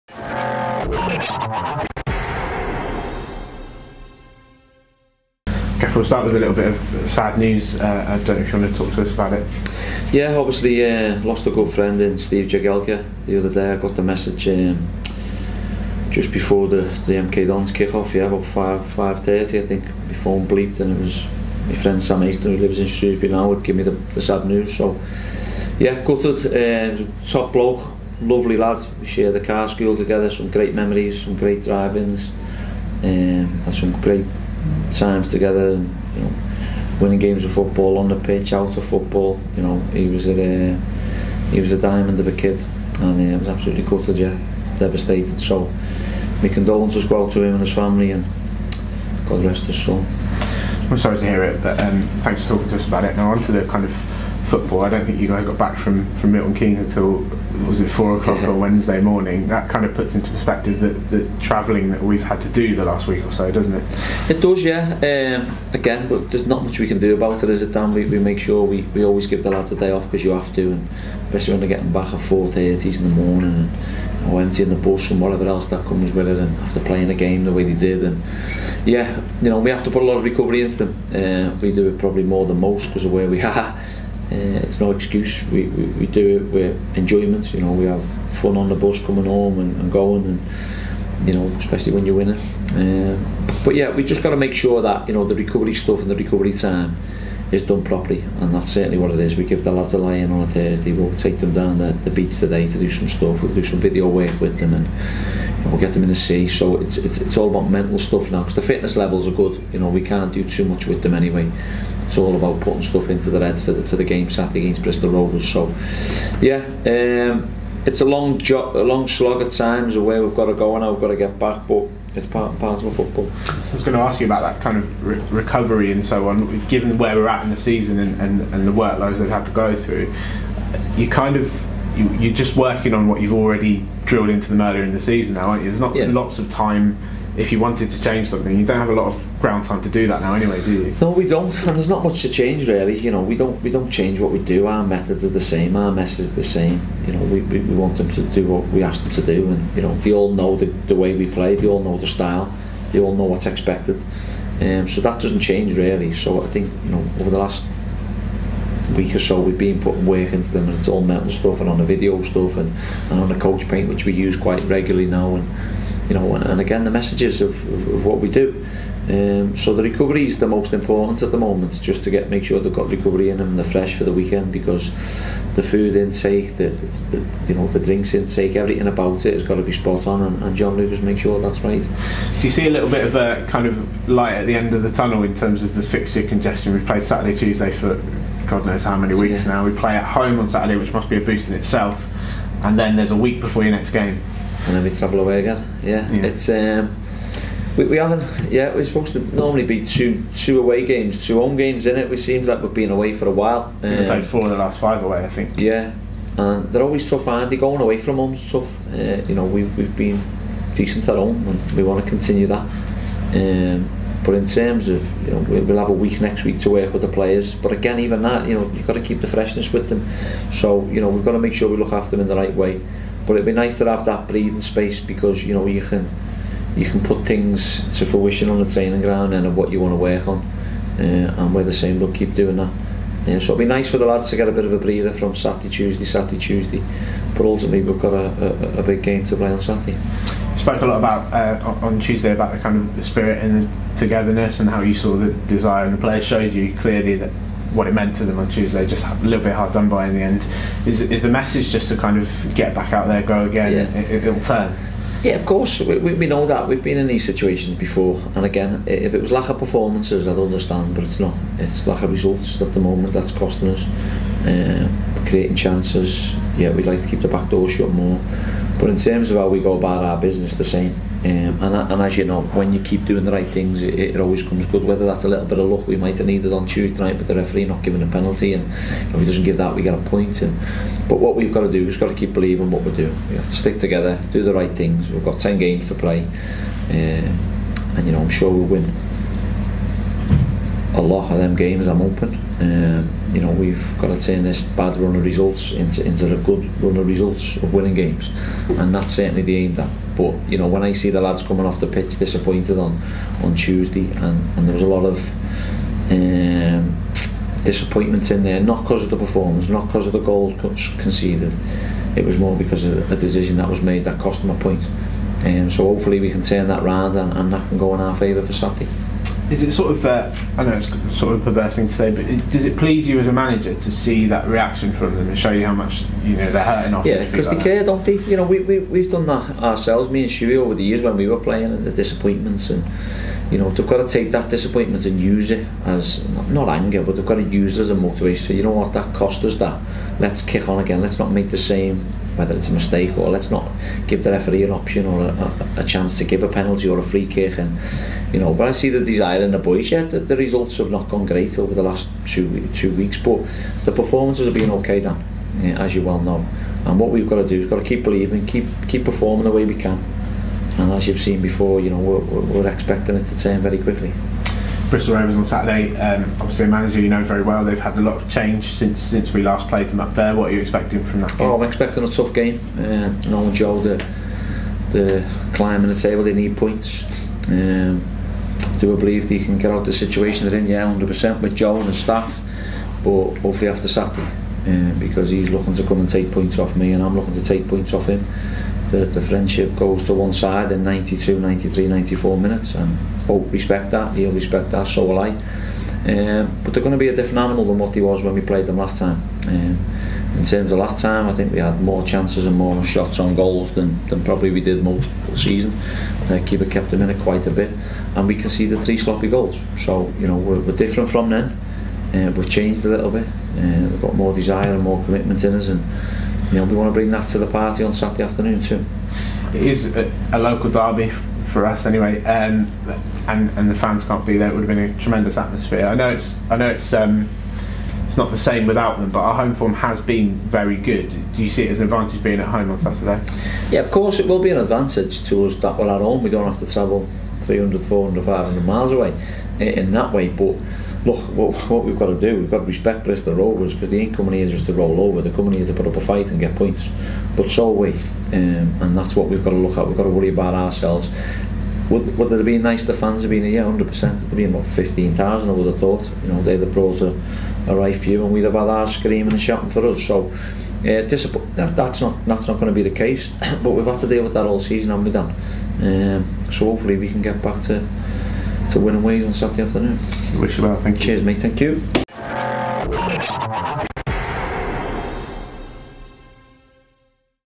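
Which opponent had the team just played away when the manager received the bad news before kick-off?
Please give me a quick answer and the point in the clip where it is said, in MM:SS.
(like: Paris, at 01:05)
MK Dons, at 00:17.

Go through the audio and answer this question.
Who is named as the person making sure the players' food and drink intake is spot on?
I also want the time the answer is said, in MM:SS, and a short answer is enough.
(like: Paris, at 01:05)
John Lucas, at 03:00.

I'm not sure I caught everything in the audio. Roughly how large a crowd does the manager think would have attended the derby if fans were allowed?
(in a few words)
15,000.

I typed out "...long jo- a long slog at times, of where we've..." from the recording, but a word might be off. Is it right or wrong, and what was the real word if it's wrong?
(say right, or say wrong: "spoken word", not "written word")
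right.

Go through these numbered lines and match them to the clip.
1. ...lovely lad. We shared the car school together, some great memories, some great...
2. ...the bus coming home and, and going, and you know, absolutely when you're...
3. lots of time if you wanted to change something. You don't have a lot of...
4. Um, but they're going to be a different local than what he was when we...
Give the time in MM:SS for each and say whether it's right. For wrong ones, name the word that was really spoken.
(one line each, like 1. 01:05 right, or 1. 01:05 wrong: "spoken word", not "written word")
1. 00:28 right
2. 01:28 wrong: "especially", not "absolutely"
3. 02:16 right
4. 06:36 wrong: "animal", not "local".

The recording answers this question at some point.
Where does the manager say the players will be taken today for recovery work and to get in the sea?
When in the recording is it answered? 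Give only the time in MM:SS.
01:41.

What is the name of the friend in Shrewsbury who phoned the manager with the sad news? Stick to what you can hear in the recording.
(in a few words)
Sam Easton.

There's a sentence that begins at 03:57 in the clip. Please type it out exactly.
But ultimately, we've got a, a, a big game to play on Saturday.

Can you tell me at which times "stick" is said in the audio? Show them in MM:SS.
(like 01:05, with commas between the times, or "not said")
04:43.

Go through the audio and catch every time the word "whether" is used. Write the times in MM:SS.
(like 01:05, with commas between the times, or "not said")
04:34, 05:42.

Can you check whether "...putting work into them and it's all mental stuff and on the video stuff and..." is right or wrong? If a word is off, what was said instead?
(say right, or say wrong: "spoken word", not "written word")
right.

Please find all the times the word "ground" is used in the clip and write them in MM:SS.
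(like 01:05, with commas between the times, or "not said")
02:19, 03:49.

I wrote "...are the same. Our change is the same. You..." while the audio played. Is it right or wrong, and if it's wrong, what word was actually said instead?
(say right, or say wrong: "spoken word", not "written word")
wrong: "message", not "change".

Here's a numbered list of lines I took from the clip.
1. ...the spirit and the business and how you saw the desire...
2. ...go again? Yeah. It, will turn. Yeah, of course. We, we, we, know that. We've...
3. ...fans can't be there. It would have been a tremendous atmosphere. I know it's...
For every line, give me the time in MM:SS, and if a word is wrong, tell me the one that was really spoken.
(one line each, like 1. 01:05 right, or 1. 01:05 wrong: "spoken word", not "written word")
1. 04:02 wrong: "togetherness", not "business"
2. 04:13 right
3. 07:03 right.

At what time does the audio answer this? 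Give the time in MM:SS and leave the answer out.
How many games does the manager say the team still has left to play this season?
04:45.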